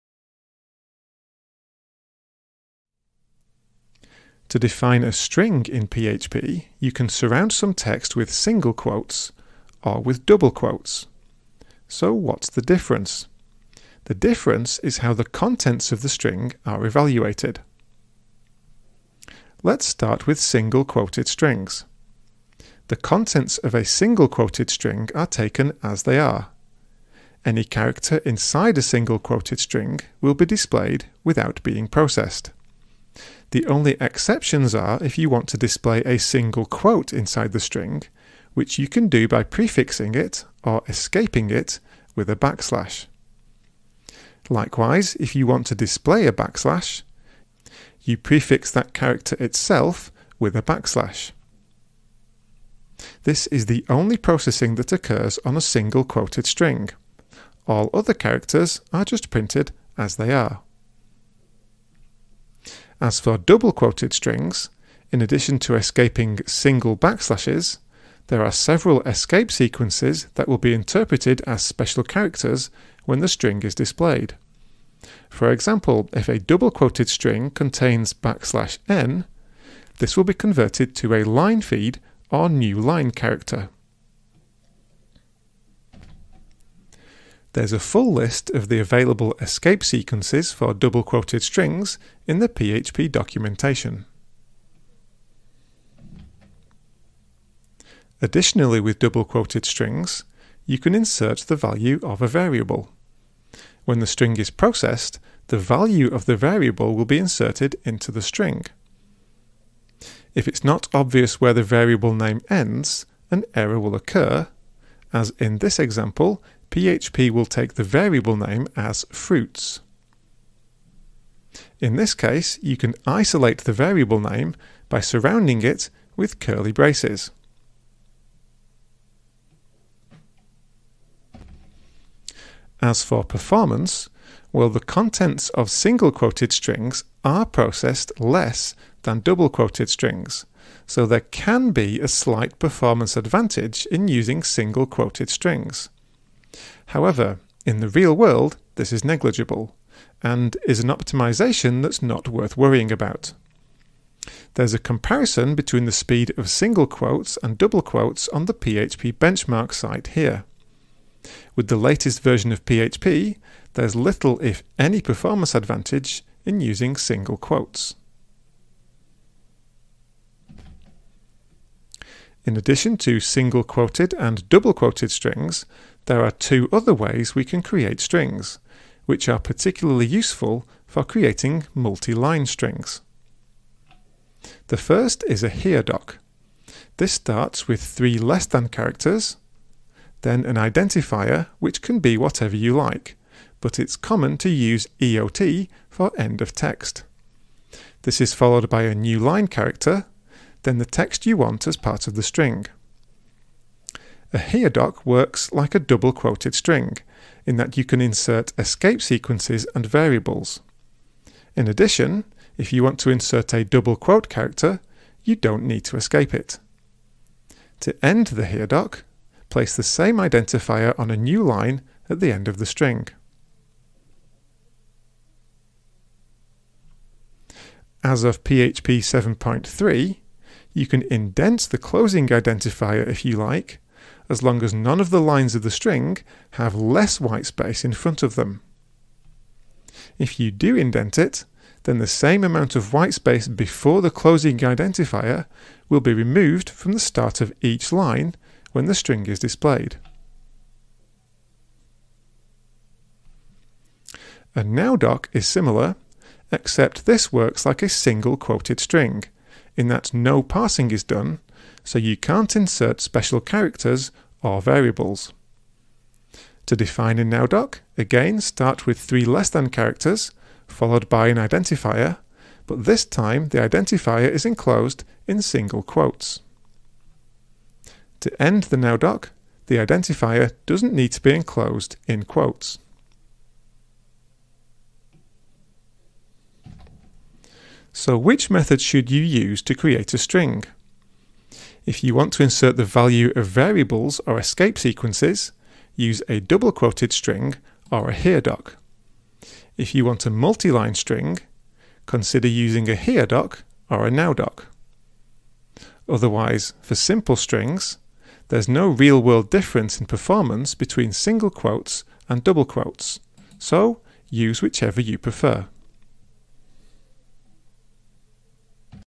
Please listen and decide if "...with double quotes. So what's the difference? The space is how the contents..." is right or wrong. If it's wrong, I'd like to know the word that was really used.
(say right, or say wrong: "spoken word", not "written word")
wrong: "difference", not "space".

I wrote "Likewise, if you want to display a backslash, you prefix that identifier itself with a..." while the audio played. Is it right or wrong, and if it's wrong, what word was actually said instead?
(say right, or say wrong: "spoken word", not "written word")
wrong: "character", not "identifier".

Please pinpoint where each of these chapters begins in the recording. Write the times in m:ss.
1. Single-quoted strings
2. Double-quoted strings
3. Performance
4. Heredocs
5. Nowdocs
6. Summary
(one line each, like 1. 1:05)
1. 0:19
2. 1:01
3. 2:10
4. 2:49
5. 4:12
6. 4:46.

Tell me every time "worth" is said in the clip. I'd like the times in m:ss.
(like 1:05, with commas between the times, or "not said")
2:32.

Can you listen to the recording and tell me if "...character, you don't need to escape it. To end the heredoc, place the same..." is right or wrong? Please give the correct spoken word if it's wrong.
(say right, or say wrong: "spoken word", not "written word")
right.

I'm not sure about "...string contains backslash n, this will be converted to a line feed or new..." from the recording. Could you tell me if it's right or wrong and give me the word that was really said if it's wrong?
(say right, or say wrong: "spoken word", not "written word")
right.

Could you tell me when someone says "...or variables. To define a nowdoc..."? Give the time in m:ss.
4:24.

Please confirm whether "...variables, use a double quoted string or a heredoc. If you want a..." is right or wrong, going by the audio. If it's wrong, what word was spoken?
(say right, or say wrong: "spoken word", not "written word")
wrong: "sequences", not "variables".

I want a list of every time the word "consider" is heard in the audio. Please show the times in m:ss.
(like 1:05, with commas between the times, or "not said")
5:02.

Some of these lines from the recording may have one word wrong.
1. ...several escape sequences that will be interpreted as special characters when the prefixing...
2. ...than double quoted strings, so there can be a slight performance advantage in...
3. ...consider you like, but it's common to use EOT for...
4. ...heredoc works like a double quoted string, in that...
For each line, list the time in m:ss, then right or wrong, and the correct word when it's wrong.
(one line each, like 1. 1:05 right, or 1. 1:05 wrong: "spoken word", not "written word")
1. 1:08 wrong: "string", not "prefixing"
2. 2:19 right
3. 3:12 wrong: "whatever", not "consider"
4. 3:24 right.